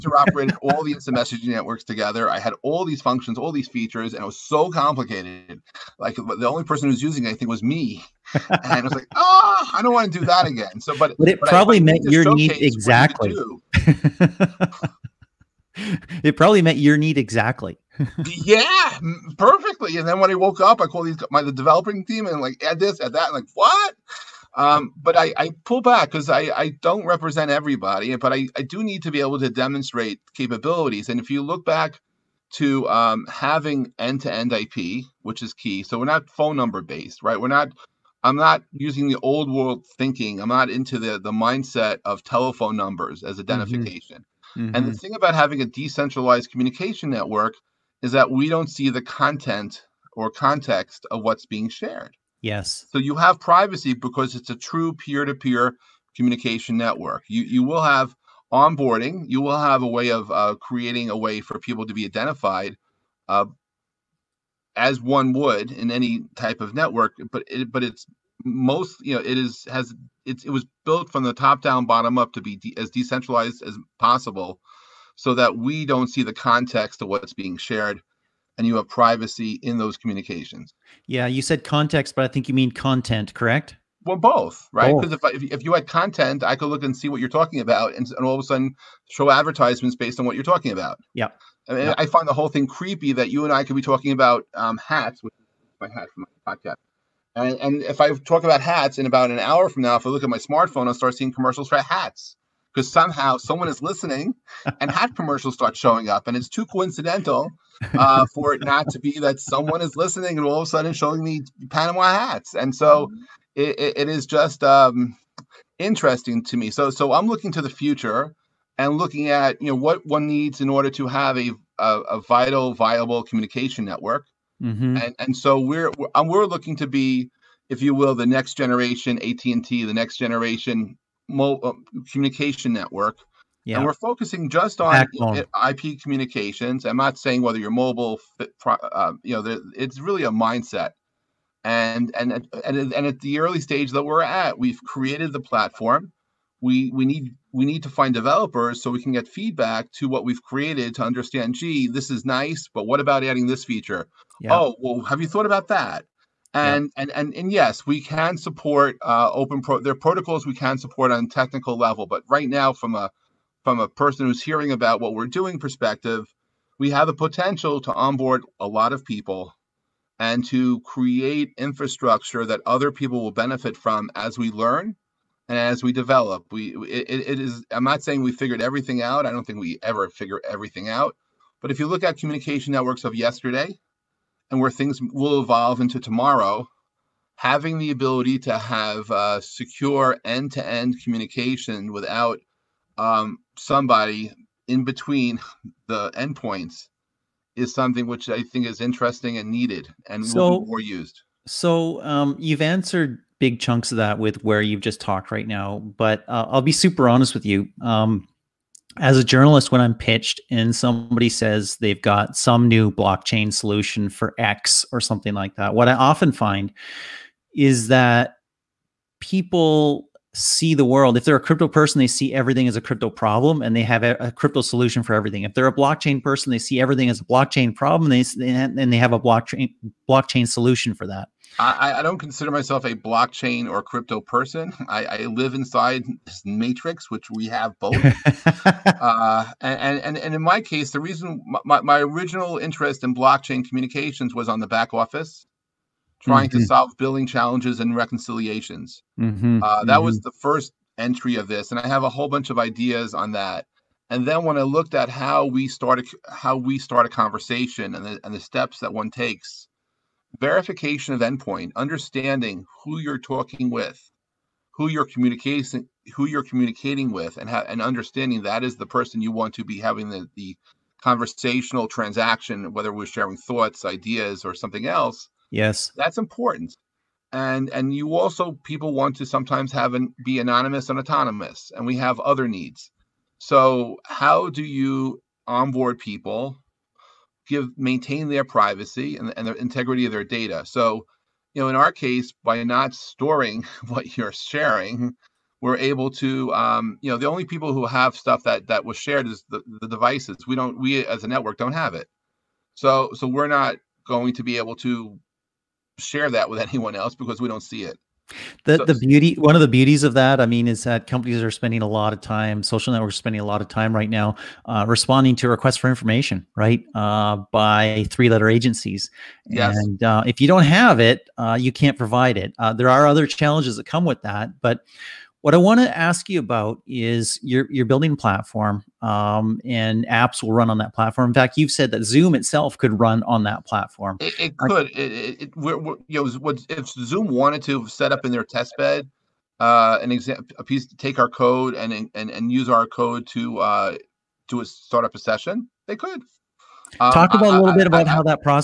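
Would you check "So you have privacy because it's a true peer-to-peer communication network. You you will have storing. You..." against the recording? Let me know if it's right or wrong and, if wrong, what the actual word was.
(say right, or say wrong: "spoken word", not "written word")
wrong: "onboarding", not "storing".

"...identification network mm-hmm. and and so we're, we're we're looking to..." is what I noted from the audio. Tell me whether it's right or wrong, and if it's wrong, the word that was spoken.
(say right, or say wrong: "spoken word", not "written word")
wrong: "communication", not "identification".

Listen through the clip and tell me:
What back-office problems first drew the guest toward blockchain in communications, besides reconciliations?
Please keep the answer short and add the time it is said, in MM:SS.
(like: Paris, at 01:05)
billing challenges, at 04:06.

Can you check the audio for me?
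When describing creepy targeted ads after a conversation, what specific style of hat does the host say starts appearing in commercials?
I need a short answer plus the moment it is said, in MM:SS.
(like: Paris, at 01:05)
panama hats, at 01:51.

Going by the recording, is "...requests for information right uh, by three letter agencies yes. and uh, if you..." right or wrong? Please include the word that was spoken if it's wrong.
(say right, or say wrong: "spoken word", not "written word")
right.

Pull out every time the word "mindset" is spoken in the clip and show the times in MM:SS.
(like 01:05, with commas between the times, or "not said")
00:41, 02:20.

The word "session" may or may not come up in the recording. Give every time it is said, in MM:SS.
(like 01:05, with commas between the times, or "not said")
05:45.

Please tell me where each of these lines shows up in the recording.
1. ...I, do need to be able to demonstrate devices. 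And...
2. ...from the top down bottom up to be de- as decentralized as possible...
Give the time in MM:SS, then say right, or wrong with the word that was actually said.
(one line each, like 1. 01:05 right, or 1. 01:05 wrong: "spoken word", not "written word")
1. 00:28 wrong: "capabilities", not "devices"
2. 01:11 right.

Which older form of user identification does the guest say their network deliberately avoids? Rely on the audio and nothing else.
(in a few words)
telephone numbers.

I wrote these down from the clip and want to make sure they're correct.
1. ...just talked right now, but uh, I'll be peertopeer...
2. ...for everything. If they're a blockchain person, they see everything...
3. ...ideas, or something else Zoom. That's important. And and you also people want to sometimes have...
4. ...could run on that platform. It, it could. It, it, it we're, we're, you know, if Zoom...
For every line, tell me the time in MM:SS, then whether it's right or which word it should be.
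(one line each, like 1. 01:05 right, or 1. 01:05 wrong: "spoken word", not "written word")
1. 03:24 wrong: "super", not "peertopeer"
2. 03:45 right
3. 04:33 wrong: "Yes", not "Zoom"
4. 05:32 right.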